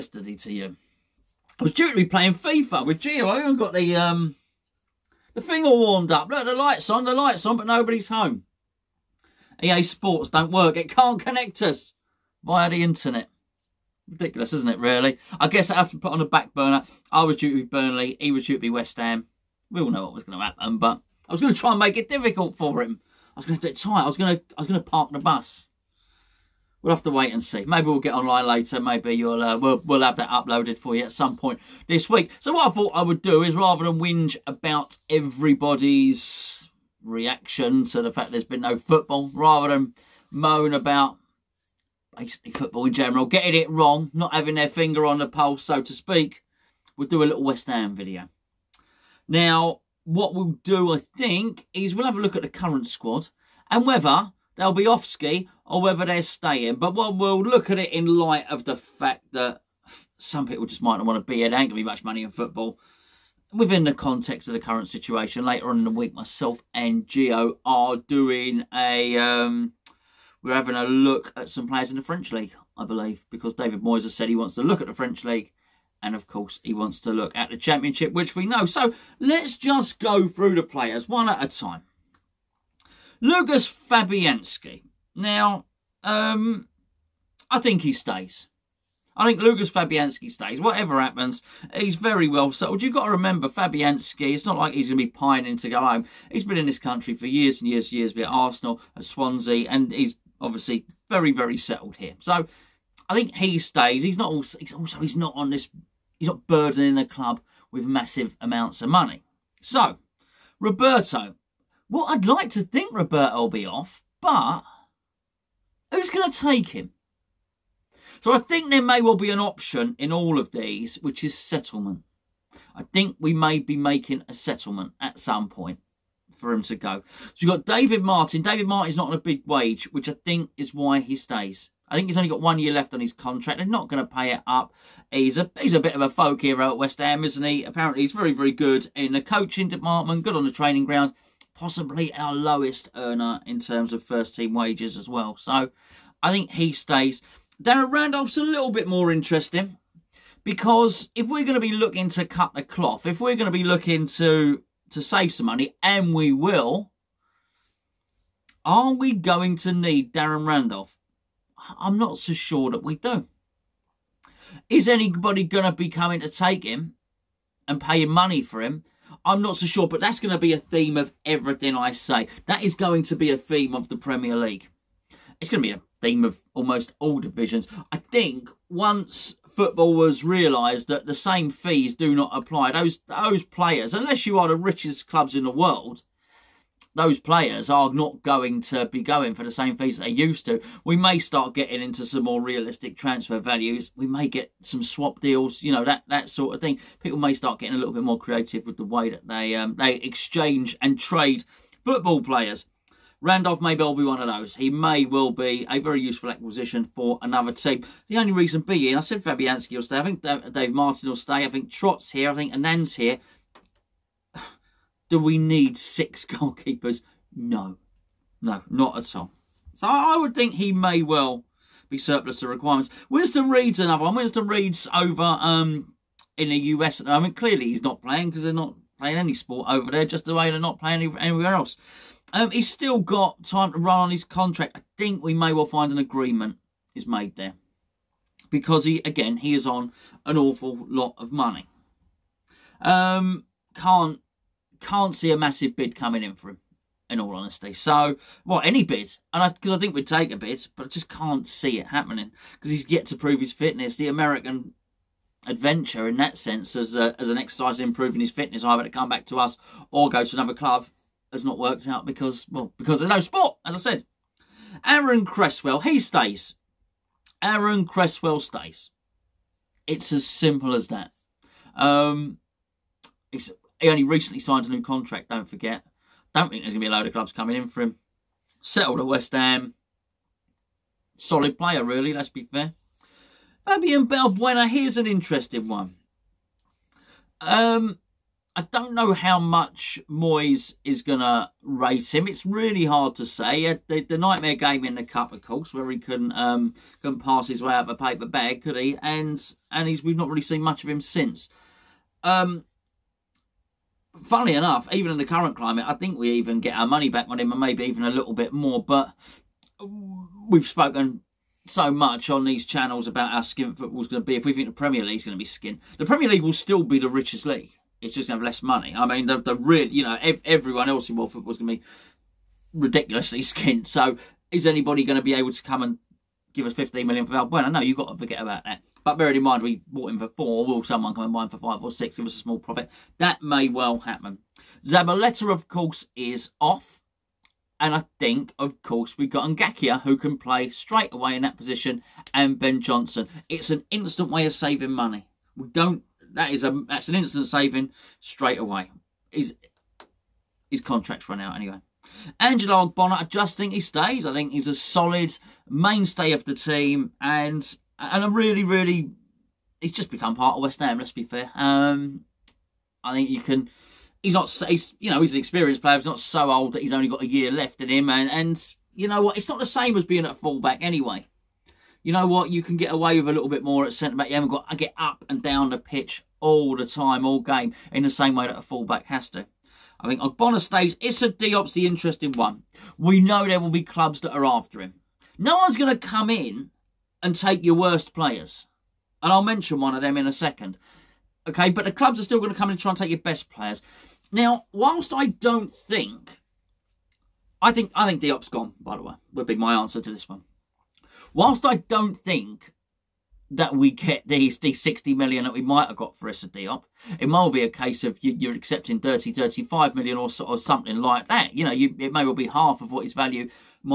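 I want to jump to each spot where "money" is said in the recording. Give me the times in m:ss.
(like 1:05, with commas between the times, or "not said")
1:02, 1:48, 2:35, 2:48, 4:01, 5:06, 5:18, 5:44.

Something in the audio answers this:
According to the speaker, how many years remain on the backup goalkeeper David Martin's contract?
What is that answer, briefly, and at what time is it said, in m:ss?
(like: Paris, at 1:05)
1, at 2:12.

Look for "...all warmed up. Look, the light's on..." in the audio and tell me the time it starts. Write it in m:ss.
0:05.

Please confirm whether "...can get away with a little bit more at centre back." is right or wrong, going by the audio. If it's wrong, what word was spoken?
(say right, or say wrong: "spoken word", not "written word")
right.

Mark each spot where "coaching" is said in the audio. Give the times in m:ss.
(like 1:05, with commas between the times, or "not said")
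2:19.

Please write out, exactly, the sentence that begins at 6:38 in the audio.
By the way, would be my answer to this one.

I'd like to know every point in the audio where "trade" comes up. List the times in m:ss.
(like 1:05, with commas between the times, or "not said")
3:20.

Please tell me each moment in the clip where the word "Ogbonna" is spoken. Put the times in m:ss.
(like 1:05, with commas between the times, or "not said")
5:52, 6:20.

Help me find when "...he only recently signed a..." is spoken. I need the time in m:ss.
4:33.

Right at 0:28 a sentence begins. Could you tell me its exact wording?
Maybe you'll uh, we'll, we'll have that uploaded for you at some point this week.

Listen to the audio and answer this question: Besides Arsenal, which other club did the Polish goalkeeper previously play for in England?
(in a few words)
Swansea.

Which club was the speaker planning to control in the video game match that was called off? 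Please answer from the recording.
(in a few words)
Burnley.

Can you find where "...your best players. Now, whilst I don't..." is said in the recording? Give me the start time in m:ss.
6:33.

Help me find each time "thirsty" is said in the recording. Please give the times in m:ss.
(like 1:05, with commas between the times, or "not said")
not said.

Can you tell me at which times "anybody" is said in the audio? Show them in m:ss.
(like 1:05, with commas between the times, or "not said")
2:44, 5:24.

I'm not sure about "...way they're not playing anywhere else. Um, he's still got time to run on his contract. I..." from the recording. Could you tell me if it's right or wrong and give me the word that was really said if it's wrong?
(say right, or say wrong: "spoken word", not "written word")
right.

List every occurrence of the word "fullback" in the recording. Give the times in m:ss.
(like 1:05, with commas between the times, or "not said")
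6:10, 6:18.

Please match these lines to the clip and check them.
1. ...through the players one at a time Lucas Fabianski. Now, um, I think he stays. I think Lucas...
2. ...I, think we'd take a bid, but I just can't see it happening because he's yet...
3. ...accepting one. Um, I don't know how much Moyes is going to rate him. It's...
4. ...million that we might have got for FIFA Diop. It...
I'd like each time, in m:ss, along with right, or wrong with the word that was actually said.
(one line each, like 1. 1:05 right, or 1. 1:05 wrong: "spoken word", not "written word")
1. 1:20 right
2. 4:09 right
3. 4:45 wrong: "interesting", not "accepting"
4. 6:45 wrong: "Issa", not "FIFA".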